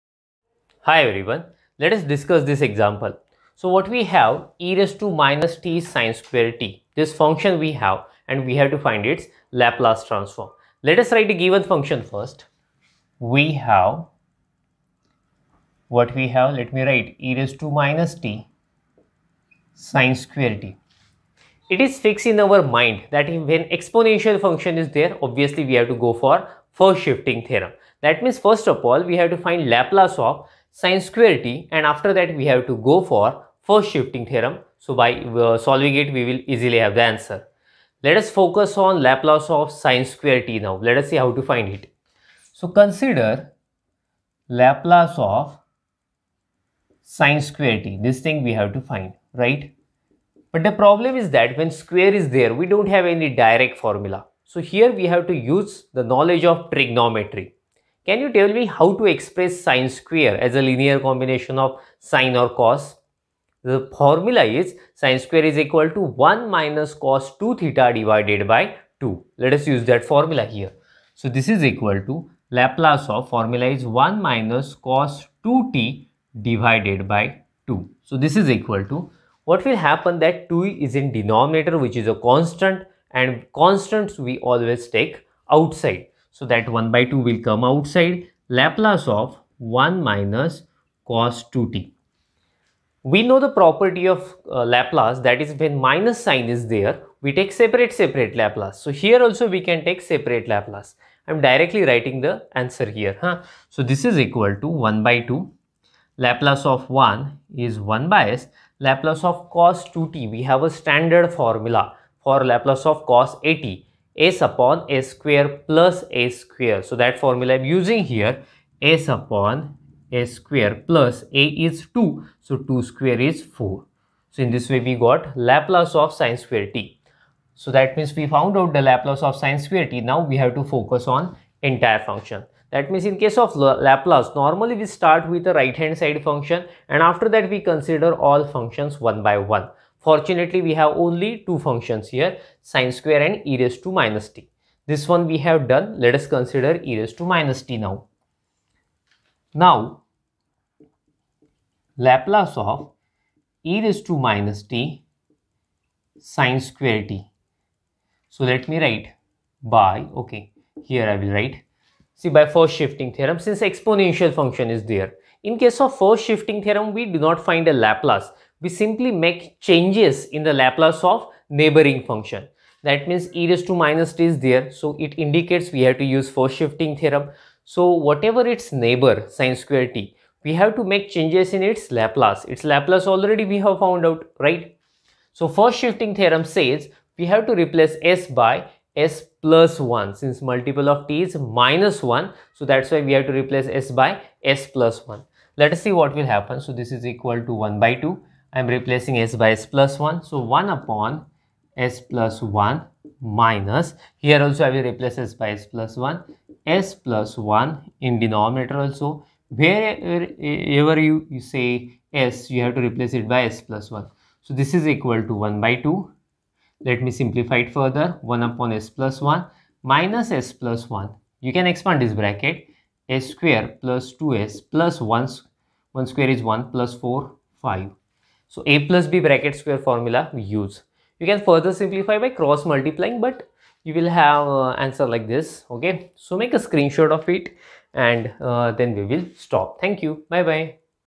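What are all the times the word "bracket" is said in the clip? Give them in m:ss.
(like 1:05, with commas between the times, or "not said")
3:42, 3:49.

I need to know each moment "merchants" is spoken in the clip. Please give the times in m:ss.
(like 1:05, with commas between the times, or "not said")
not said.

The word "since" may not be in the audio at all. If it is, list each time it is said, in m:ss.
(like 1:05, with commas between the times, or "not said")
2:43, 3:10.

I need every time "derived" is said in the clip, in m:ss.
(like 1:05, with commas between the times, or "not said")
not said.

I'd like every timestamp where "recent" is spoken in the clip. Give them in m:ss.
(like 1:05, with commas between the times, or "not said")
not said.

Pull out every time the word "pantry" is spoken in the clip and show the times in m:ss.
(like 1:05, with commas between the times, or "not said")
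not said.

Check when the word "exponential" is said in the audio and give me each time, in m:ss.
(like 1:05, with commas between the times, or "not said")
0:23, 2:43.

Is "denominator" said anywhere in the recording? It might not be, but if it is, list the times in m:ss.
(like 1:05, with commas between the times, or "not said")
1:21, 3:28.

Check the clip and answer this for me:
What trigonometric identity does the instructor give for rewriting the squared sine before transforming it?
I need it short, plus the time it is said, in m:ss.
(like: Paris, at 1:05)
1 minus cos 2 theta divided by 2, at 1:06.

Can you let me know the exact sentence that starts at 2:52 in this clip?
That means e raised to minus t is there.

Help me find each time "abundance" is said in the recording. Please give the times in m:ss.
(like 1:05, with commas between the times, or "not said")
not said.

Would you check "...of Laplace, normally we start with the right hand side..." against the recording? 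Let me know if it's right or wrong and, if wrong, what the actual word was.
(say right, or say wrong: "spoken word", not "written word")
right.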